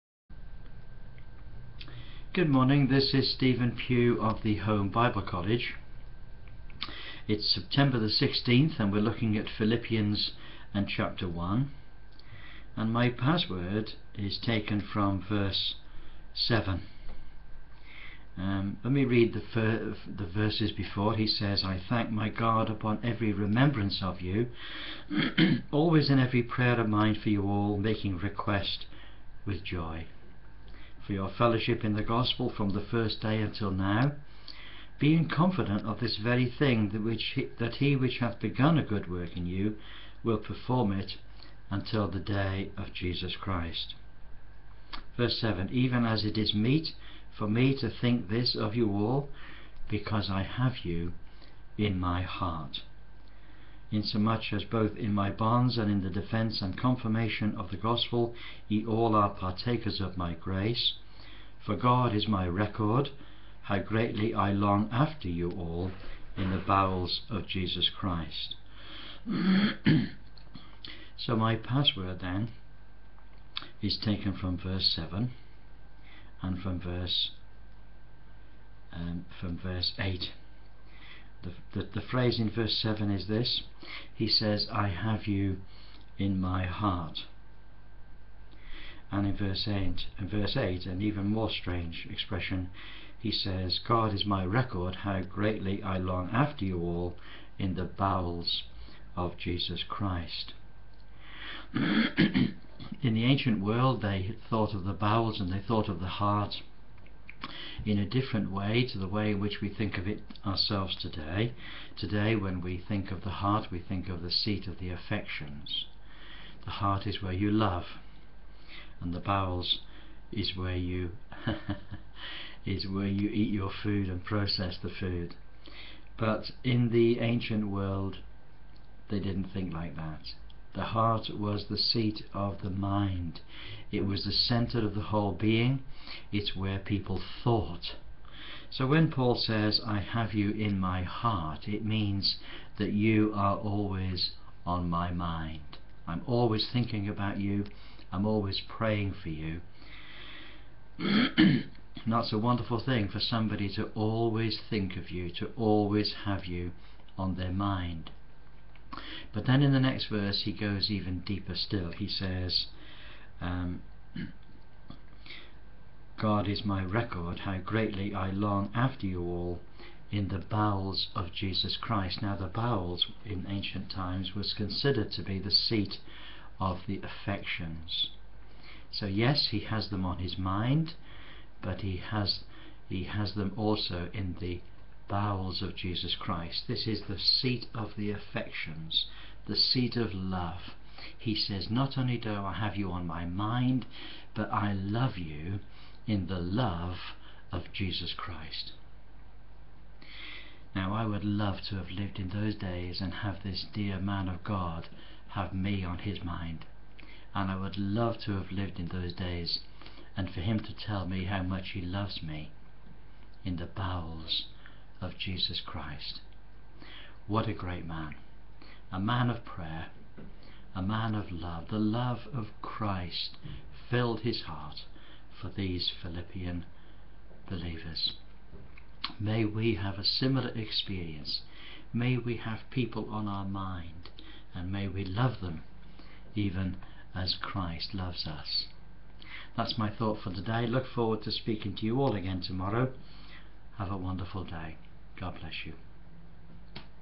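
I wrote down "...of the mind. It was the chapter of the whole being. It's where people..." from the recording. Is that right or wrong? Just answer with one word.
wrong.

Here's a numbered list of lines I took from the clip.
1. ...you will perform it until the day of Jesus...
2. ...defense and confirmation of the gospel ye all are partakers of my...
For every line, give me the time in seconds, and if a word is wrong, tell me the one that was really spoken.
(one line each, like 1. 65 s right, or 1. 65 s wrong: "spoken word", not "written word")
1. 39 s right
2. 56 s right.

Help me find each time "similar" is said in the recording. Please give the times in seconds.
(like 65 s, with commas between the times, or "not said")
230 s.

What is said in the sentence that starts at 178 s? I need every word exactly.
So, yes, he has them on his mind, but he has, he has them also in the bowels of Jesus Christ.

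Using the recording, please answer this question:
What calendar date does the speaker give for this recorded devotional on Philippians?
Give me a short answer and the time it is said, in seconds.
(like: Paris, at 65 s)
September 16, at 7 s.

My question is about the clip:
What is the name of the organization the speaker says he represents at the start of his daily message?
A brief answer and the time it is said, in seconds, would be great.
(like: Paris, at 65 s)
Home Bible College, at 4 s.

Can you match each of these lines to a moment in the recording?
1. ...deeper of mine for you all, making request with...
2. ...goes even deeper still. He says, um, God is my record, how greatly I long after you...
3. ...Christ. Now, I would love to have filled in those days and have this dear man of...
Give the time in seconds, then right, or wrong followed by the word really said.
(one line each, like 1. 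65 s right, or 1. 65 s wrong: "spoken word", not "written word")
1. 26 s wrong: "prayer", not "deeper"
2. 160 s right
3. 198 s wrong: "lived", not "filled".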